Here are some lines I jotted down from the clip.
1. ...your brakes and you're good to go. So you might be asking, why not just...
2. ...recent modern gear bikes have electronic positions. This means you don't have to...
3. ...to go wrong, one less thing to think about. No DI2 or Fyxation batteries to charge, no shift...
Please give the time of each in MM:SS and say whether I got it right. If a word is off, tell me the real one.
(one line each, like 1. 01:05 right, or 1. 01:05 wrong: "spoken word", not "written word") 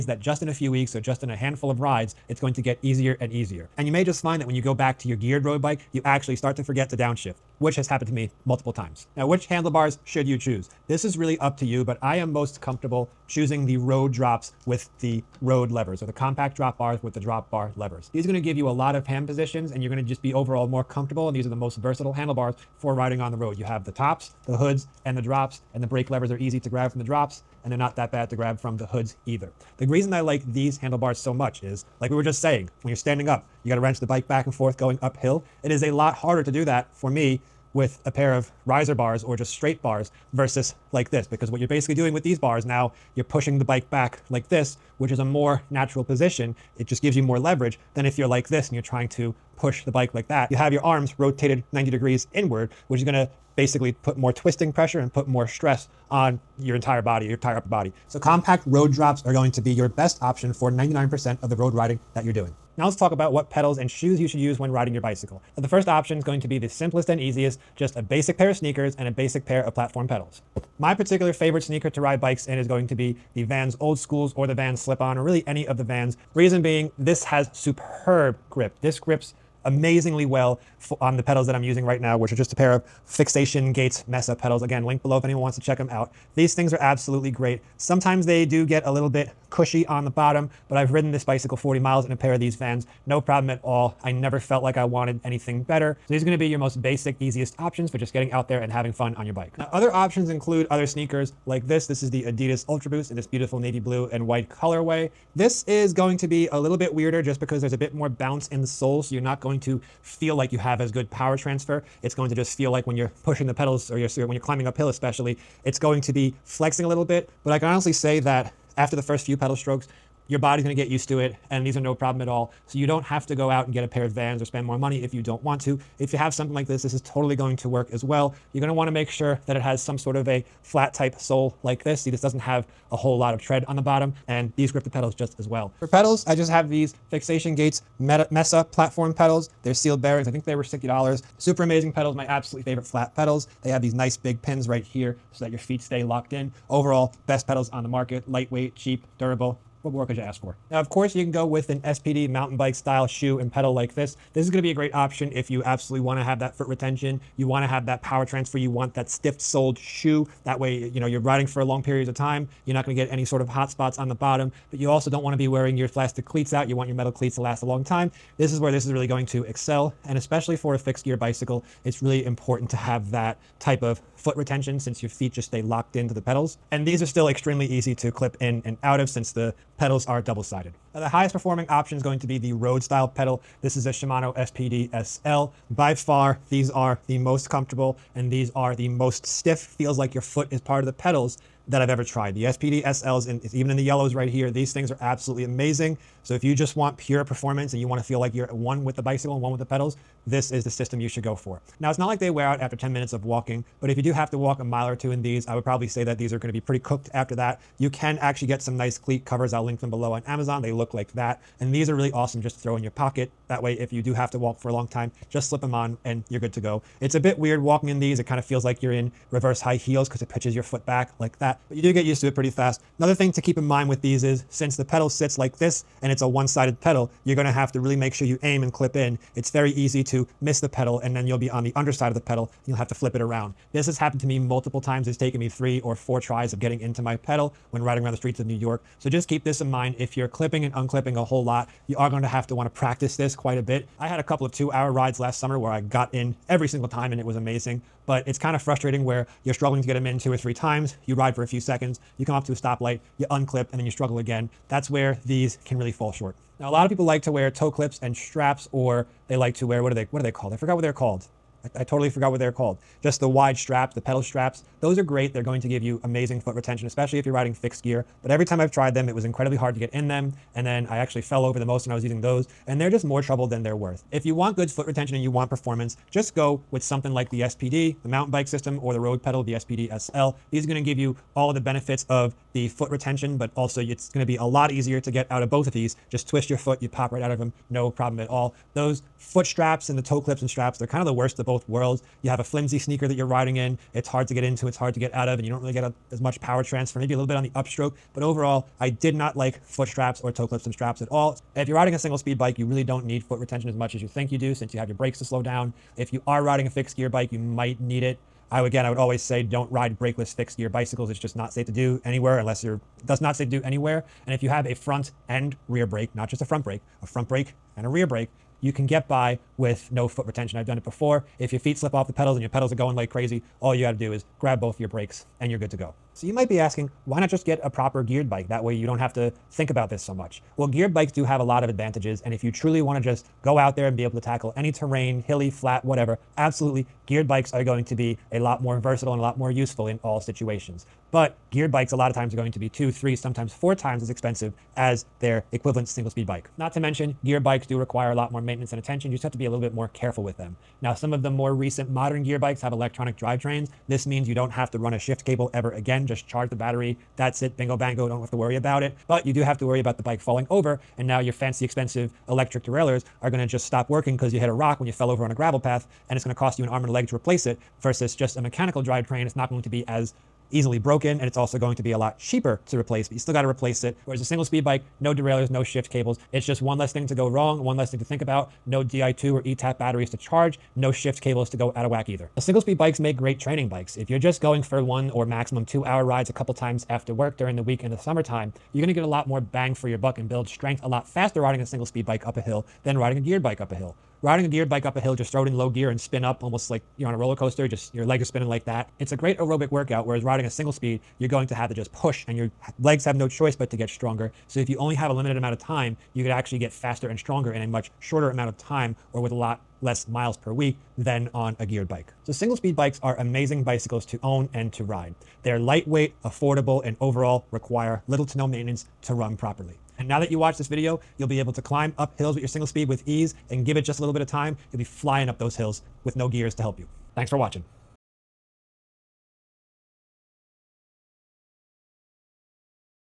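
1. 05:24 right
2. 05:51 wrong: "drivetrains", not "positions"
3. 06:17 wrong: "ETAP", not "Fyxation".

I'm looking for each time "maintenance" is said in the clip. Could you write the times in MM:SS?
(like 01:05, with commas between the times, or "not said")
05:48, 06:58.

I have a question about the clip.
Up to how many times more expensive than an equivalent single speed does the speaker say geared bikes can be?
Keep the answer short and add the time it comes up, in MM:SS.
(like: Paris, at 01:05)
4 times, at 05:43.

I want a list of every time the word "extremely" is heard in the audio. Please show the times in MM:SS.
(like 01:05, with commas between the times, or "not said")
02:57.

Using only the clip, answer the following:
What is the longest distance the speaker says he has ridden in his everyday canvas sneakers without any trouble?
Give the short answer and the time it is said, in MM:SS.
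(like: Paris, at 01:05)
40 miles, at 01:31.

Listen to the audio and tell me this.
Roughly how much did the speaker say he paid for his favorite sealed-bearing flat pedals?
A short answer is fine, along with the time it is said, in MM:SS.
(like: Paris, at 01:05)
$60, at 02:20.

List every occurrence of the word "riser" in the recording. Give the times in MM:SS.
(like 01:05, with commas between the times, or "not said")
00:38.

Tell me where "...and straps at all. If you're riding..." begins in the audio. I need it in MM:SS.
05:00.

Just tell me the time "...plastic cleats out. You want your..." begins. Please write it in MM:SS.
02:45.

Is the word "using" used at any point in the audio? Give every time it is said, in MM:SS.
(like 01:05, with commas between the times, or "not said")
01:21, 04:32.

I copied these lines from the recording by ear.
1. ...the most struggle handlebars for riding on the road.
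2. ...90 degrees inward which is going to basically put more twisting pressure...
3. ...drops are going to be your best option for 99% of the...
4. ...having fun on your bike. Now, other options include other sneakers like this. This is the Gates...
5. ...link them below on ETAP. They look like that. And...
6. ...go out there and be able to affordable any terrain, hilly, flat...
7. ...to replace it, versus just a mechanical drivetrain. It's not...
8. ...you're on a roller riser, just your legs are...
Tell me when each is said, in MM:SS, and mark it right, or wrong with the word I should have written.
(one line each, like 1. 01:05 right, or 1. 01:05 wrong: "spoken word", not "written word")
1. 00:21 wrong: "versatile", not "struggle"
2. 00:51 right
3. 00:58 right
4. 01:38 wrong: "Adidas", not "Gates"
5. 03:29 wrong: "Amazon", not "ETAP"
6. 05:33 wrong: "tackle", not "affordable"
7. 06:07 right
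8. 06:36 wrong: "coaster", not "riser".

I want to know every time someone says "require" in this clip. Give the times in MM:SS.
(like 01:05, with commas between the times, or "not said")
05:47, 06:57.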